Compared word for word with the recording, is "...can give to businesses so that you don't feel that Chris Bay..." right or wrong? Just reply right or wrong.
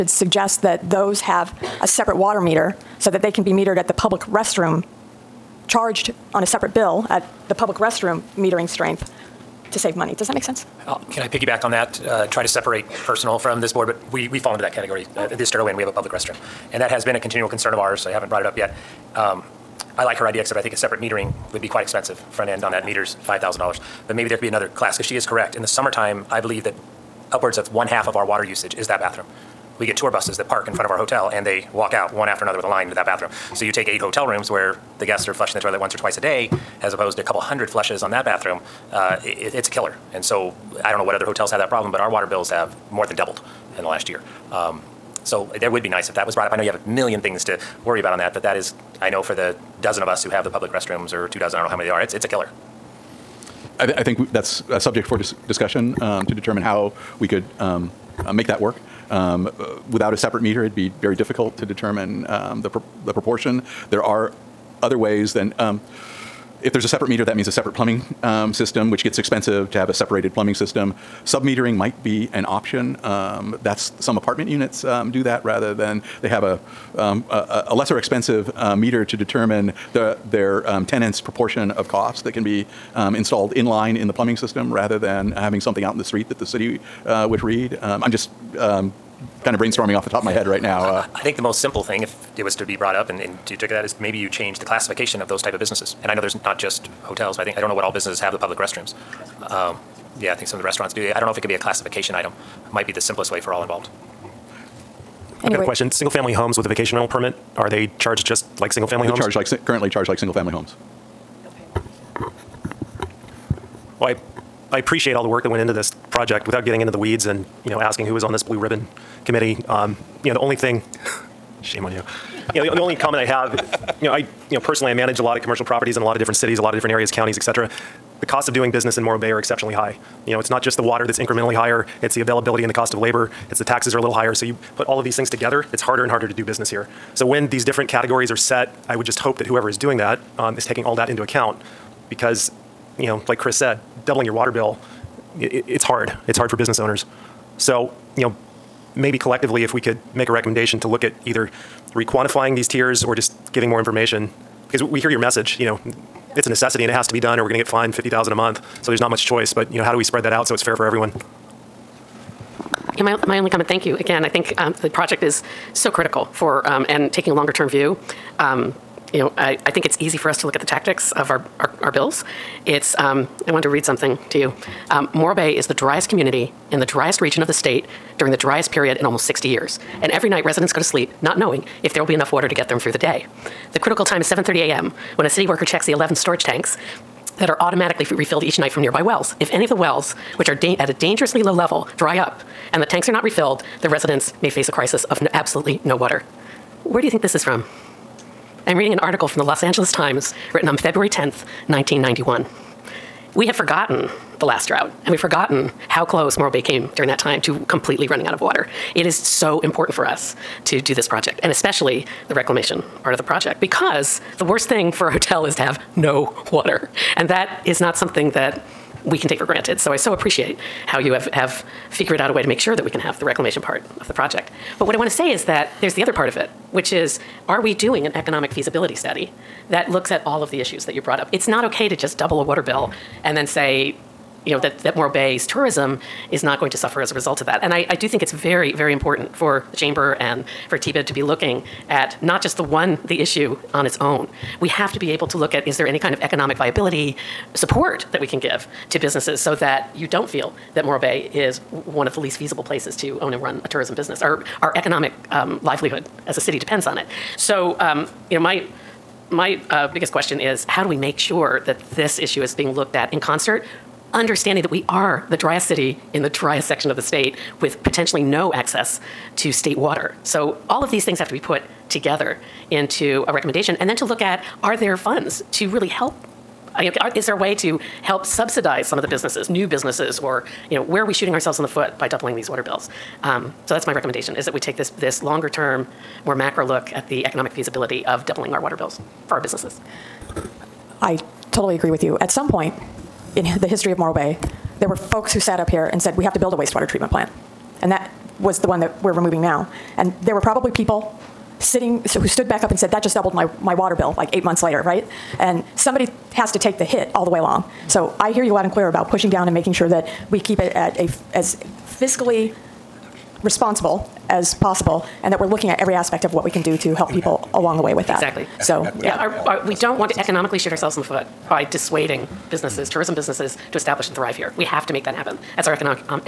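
wrong.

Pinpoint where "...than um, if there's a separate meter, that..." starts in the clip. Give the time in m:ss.
1:05.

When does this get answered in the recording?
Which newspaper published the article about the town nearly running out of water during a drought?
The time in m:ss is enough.
3:19.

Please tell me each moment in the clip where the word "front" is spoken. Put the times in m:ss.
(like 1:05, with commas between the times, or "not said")
0:22, 0:30.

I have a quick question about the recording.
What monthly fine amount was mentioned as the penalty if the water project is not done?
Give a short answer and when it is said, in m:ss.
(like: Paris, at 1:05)
50,000, at 2:37.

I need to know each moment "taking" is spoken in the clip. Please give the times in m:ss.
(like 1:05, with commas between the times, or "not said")
2:20, 2:47.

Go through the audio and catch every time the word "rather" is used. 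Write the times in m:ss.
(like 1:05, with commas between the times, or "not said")
1:15, 1:24.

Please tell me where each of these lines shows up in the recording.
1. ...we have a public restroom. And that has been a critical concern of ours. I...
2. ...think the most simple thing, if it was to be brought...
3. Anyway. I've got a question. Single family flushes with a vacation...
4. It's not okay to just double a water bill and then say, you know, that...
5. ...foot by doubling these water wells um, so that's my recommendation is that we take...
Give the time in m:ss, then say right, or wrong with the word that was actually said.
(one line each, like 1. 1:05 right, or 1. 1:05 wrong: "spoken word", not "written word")
1. 0:15 wrong: "continual", not "critical"
2. 1:31 right
3. 1:45 wrong: "homes", not "flushes"
4. 3:51 right
5. 4:41 wrong: "bills", not "wells".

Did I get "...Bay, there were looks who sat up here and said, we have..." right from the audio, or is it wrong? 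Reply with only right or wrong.
wrong.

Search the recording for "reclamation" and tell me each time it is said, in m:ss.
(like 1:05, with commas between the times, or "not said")
3:32, 3:43.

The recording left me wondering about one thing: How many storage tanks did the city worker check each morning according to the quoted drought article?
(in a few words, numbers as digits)
11.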